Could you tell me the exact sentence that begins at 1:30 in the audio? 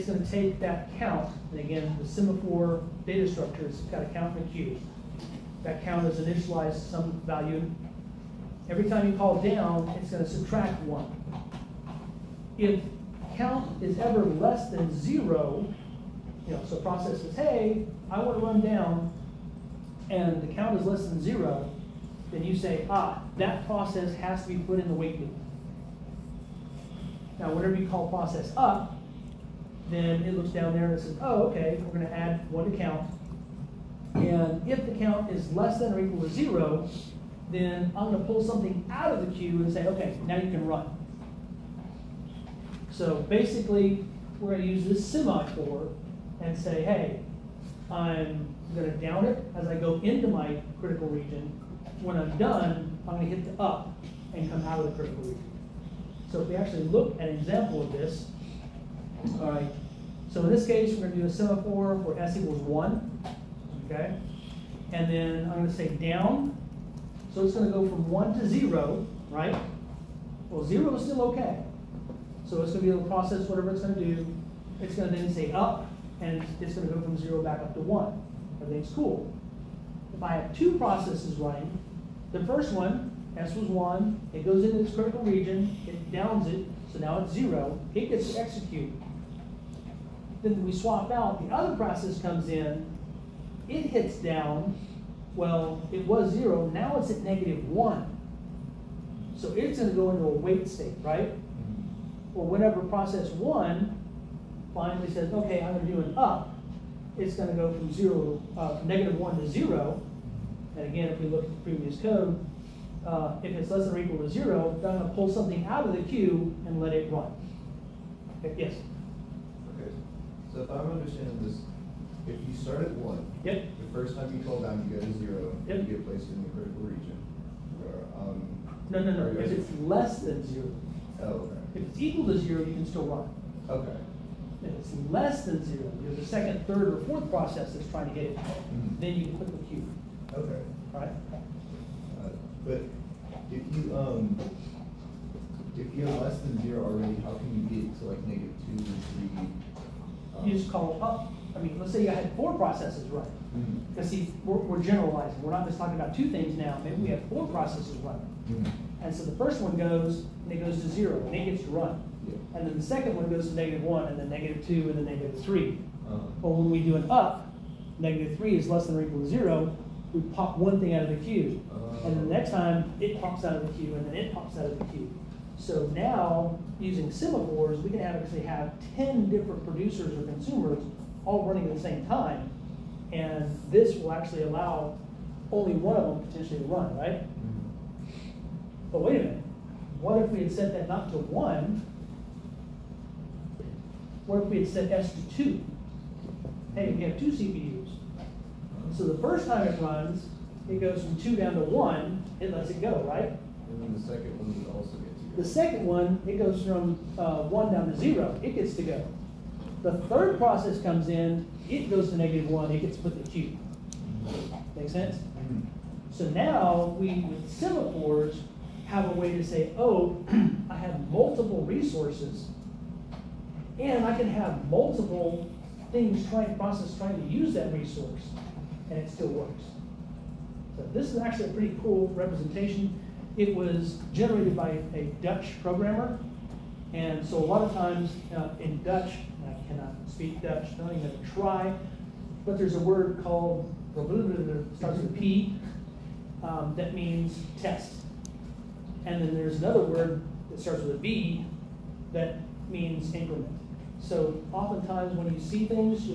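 Then we swap out, the other process comes in, it hits down, well, it was 0, now it's at negative 1.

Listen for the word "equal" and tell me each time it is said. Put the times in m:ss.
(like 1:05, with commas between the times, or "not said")
0:35, 1:02, 1:53, 2:11, 2:49.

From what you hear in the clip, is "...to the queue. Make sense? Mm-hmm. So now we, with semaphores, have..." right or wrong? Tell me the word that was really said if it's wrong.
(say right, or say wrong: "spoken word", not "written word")
right.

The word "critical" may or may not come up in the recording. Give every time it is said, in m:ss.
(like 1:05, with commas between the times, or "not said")
0:50, 0:54, 1:24, 2:06.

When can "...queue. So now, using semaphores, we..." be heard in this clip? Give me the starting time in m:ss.
2:54.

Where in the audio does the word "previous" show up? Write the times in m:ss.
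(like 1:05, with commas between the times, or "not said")
1:51.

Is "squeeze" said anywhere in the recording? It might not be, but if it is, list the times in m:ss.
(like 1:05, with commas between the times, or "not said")
not said.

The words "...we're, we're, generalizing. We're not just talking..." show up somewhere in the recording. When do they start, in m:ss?
2:34.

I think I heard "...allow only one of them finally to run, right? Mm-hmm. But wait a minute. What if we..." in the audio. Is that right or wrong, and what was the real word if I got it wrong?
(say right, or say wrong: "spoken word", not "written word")
wrong: "potentially", not "finally".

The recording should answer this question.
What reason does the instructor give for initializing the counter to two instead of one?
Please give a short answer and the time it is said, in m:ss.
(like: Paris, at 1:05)
two CPUs, at 3:17.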